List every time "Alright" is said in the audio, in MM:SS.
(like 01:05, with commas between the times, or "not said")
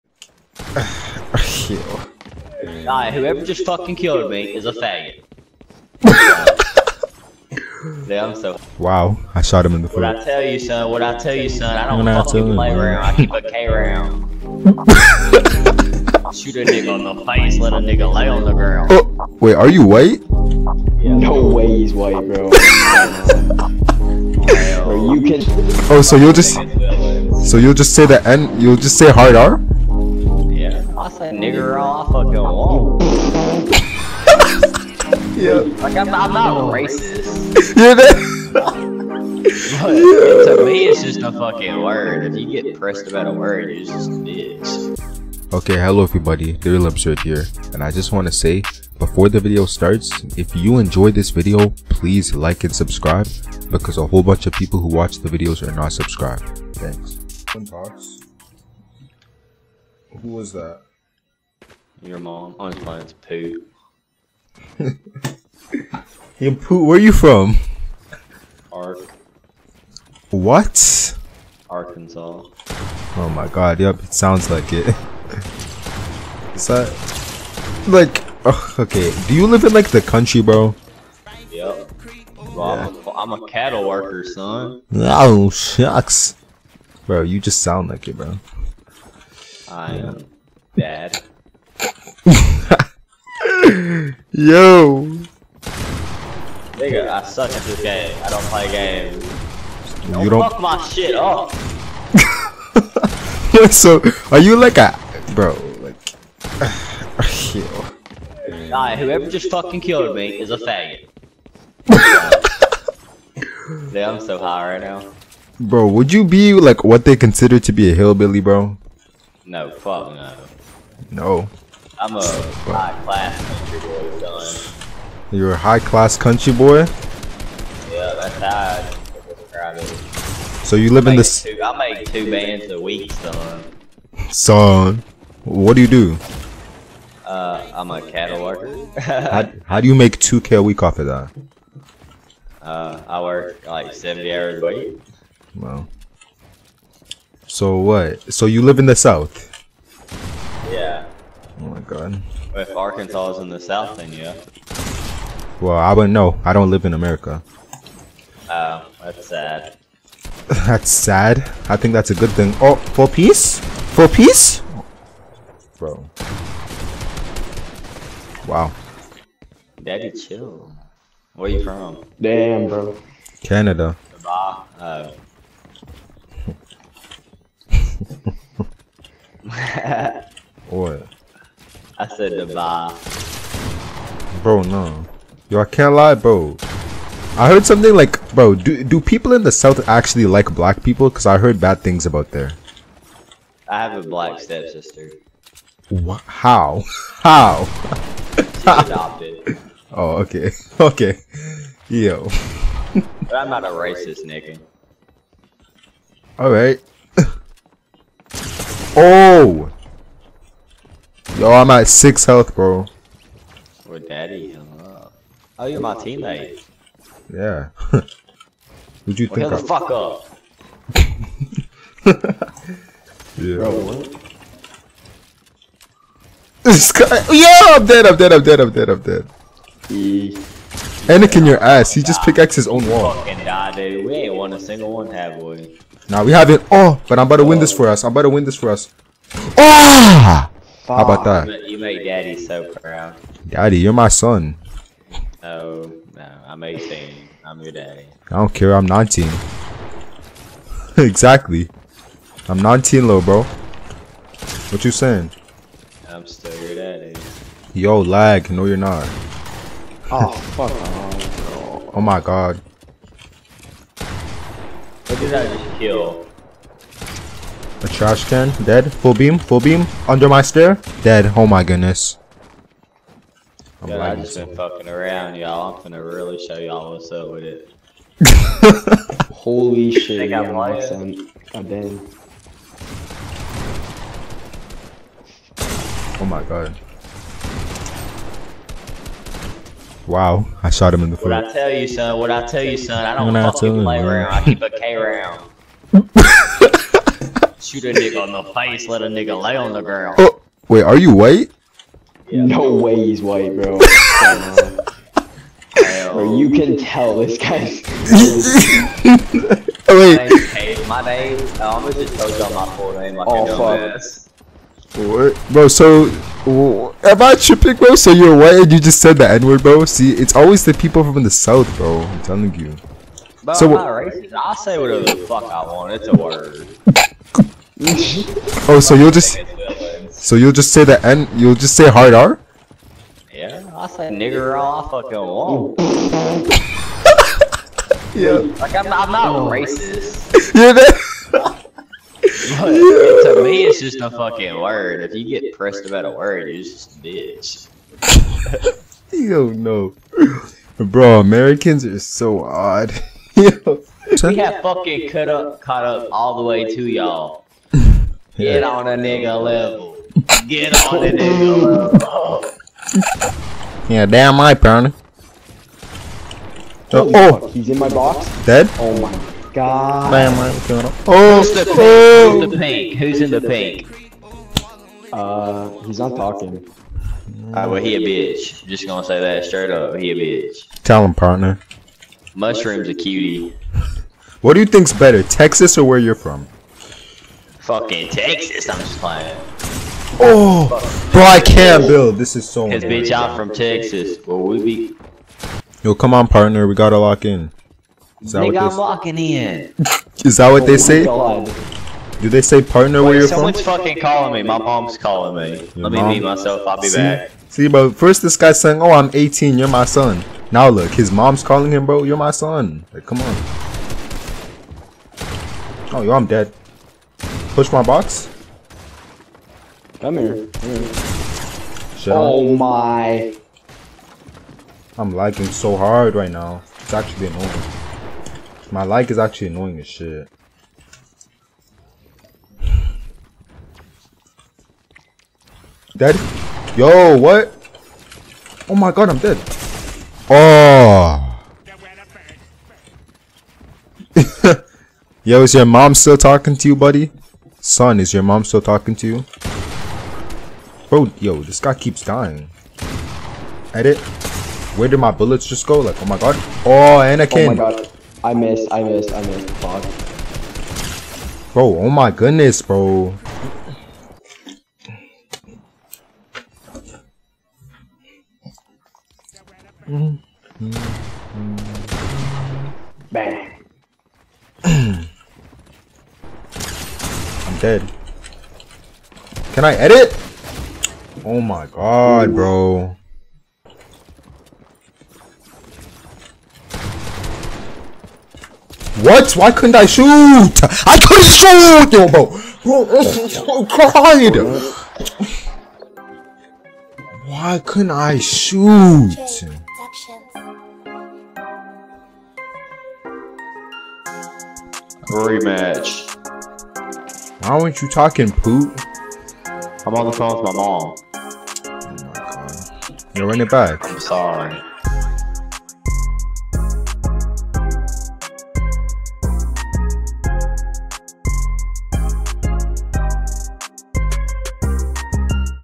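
00:02, 01:48, 03:26, 06:17.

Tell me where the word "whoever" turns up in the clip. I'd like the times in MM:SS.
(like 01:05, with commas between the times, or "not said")
00:03, 01:48.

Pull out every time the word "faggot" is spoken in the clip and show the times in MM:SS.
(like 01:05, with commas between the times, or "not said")
00:04, 01:50.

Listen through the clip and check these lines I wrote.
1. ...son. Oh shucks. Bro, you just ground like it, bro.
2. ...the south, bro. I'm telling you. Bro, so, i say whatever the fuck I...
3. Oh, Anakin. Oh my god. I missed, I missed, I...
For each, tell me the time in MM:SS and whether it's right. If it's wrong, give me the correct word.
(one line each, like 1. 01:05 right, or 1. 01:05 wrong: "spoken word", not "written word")
1. 01:24 wrong: "sound", not "ground"
2. 05:21 right
3. 07:36 right.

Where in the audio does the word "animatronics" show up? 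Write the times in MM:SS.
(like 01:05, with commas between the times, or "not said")
not said.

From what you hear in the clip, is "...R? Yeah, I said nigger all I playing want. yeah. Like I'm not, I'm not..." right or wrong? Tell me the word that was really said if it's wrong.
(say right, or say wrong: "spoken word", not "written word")
wrong: "fucking", not "playing".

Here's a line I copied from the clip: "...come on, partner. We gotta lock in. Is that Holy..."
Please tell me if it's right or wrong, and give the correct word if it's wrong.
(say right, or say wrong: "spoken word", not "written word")
wrong: "Nigga", not "Holy".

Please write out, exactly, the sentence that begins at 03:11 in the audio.
Because I heard bad things about there.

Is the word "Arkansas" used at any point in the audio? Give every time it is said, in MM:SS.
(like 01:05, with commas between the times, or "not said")
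01:11, 02:32.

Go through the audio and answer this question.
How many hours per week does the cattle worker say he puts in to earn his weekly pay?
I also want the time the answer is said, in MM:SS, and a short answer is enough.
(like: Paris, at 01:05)
70, at 02:23.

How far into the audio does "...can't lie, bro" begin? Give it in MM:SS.
03:05.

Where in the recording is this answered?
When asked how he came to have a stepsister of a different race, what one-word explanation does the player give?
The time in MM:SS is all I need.
03:18.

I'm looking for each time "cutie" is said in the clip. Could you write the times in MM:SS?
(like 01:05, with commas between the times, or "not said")
06:22.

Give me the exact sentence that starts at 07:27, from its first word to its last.
Son, is your mom still talking to you?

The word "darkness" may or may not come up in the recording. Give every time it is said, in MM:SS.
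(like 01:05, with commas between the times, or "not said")
not said.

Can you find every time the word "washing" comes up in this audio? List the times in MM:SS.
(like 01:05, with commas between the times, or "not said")
not said.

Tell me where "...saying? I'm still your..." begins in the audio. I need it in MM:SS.
04:14.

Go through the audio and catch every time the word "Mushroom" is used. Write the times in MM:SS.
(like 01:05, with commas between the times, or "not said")
06:22.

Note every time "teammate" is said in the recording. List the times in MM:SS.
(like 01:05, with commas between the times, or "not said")
03:35.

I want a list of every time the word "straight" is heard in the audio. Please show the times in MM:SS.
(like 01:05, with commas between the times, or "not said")
06:19.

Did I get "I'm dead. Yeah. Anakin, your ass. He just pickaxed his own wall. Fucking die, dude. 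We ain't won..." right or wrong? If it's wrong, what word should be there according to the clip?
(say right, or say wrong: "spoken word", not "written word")
right.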